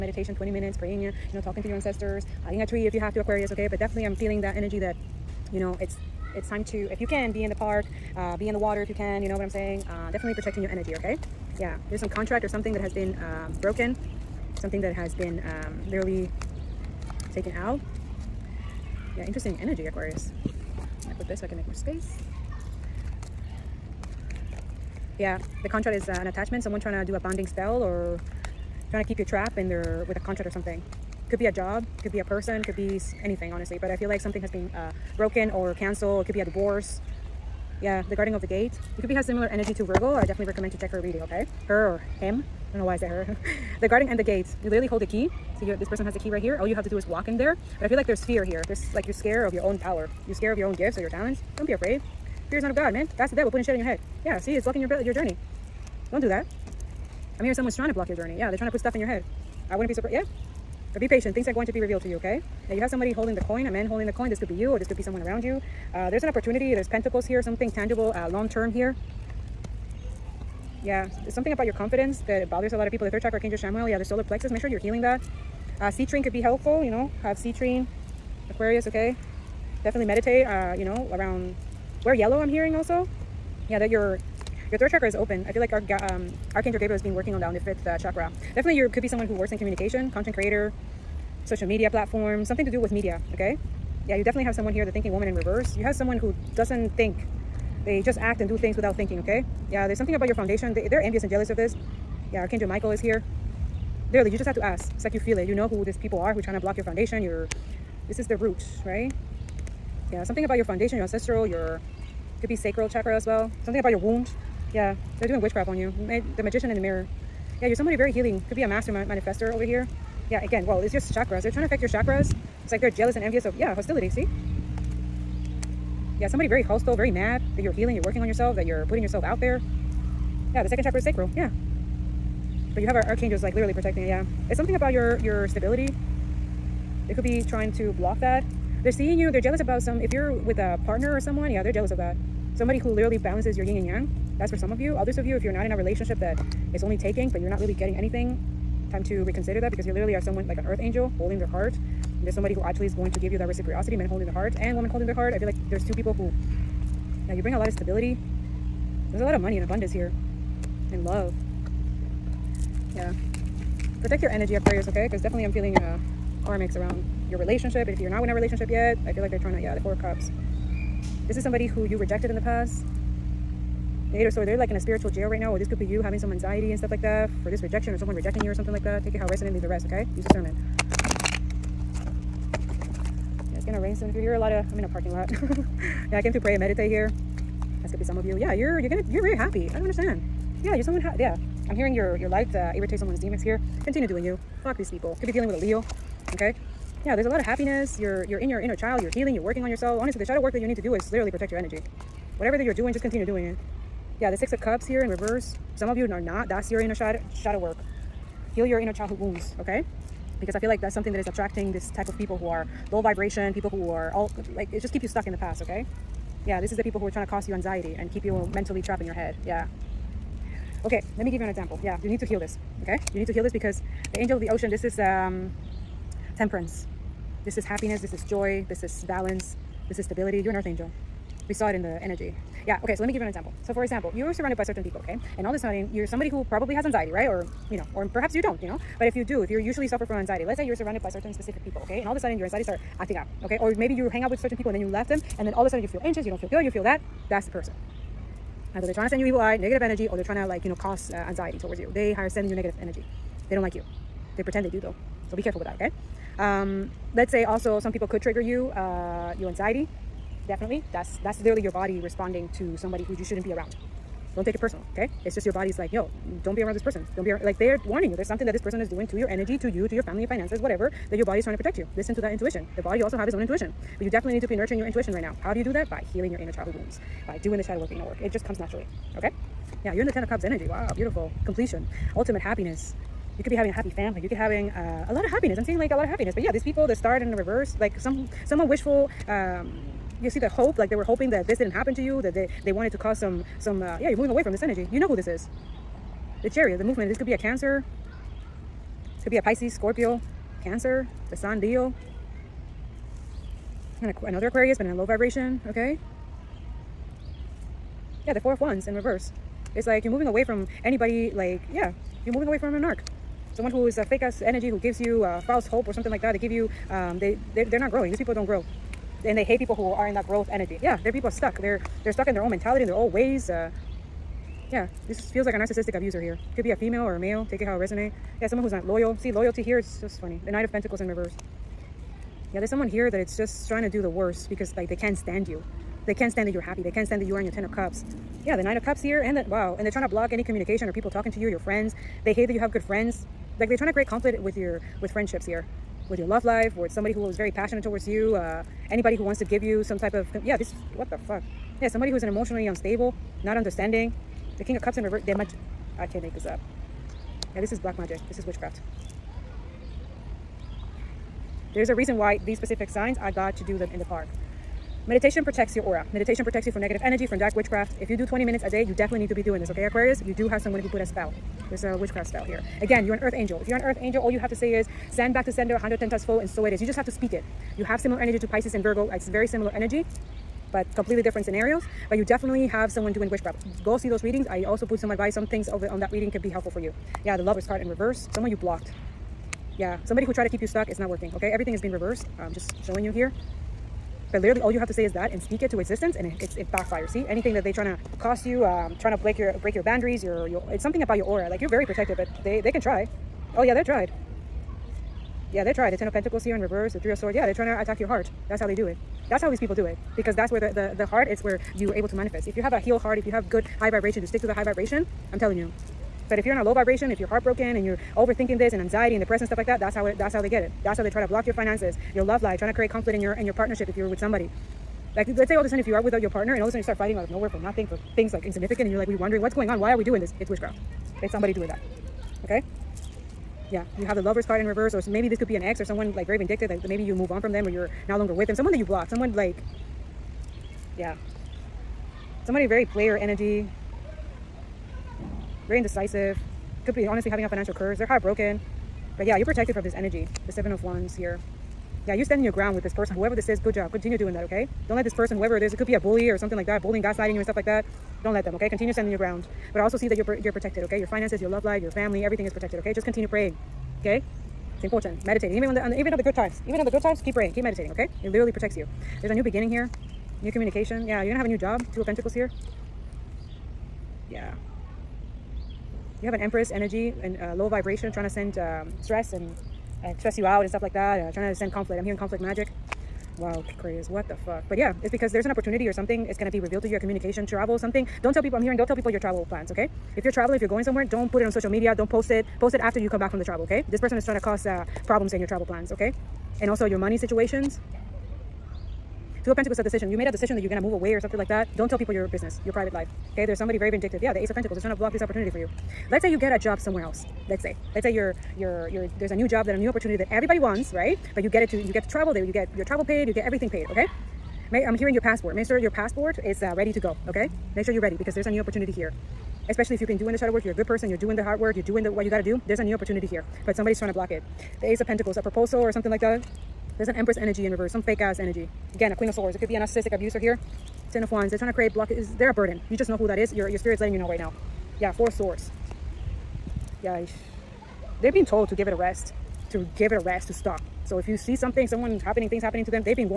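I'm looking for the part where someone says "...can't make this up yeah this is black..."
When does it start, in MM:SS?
05:56.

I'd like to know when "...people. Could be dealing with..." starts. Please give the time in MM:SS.
03:14.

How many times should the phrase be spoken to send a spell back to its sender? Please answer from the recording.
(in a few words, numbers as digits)
110.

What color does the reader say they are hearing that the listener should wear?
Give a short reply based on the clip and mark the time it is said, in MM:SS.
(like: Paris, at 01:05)
Yellow, at 01:22.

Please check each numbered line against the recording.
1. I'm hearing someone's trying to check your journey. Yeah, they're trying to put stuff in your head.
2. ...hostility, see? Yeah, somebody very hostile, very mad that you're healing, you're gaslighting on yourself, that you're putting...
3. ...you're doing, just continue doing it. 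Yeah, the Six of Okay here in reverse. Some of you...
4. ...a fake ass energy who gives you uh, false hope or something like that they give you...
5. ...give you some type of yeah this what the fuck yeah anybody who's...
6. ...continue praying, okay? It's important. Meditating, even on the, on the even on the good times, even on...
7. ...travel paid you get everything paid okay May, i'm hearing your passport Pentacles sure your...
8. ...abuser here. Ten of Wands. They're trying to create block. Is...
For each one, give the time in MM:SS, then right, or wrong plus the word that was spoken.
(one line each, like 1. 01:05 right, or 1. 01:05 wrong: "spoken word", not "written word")
1. 00:57 wrong: "block", not "check"
2. 02:03 wrong: "working", not "gaslighting"
3. 03:22 wrong: "Cups", not "Okay"
4. 05:13 right
5. 05:49 wrong: "somebody", not "anybody"
6. 07:43 right
7. 08:32 wrong: "Make", not "Pentacles"
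8. 08:50 right.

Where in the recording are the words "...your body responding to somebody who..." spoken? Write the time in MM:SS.
04:21.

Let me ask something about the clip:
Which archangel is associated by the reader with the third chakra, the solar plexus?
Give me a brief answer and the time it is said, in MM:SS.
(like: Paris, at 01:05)
Archangel Chamuel, at 01:13.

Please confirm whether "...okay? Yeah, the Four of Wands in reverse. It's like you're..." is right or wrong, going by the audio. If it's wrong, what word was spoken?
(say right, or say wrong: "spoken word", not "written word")
right.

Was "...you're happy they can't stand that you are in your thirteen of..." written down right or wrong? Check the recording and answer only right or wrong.
wrong.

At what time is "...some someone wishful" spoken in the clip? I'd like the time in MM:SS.
04:47.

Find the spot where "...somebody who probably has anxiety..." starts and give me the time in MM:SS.
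03:56.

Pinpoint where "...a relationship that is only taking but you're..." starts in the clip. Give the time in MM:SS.
02:25.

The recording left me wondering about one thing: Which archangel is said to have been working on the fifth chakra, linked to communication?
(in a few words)
Archangel Gabriel.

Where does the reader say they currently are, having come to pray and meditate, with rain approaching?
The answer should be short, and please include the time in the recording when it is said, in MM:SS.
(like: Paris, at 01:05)
Parking lot, at 03:04.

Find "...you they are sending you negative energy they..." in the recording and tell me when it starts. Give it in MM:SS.
04:11.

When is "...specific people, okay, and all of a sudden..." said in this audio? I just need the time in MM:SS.
04:01.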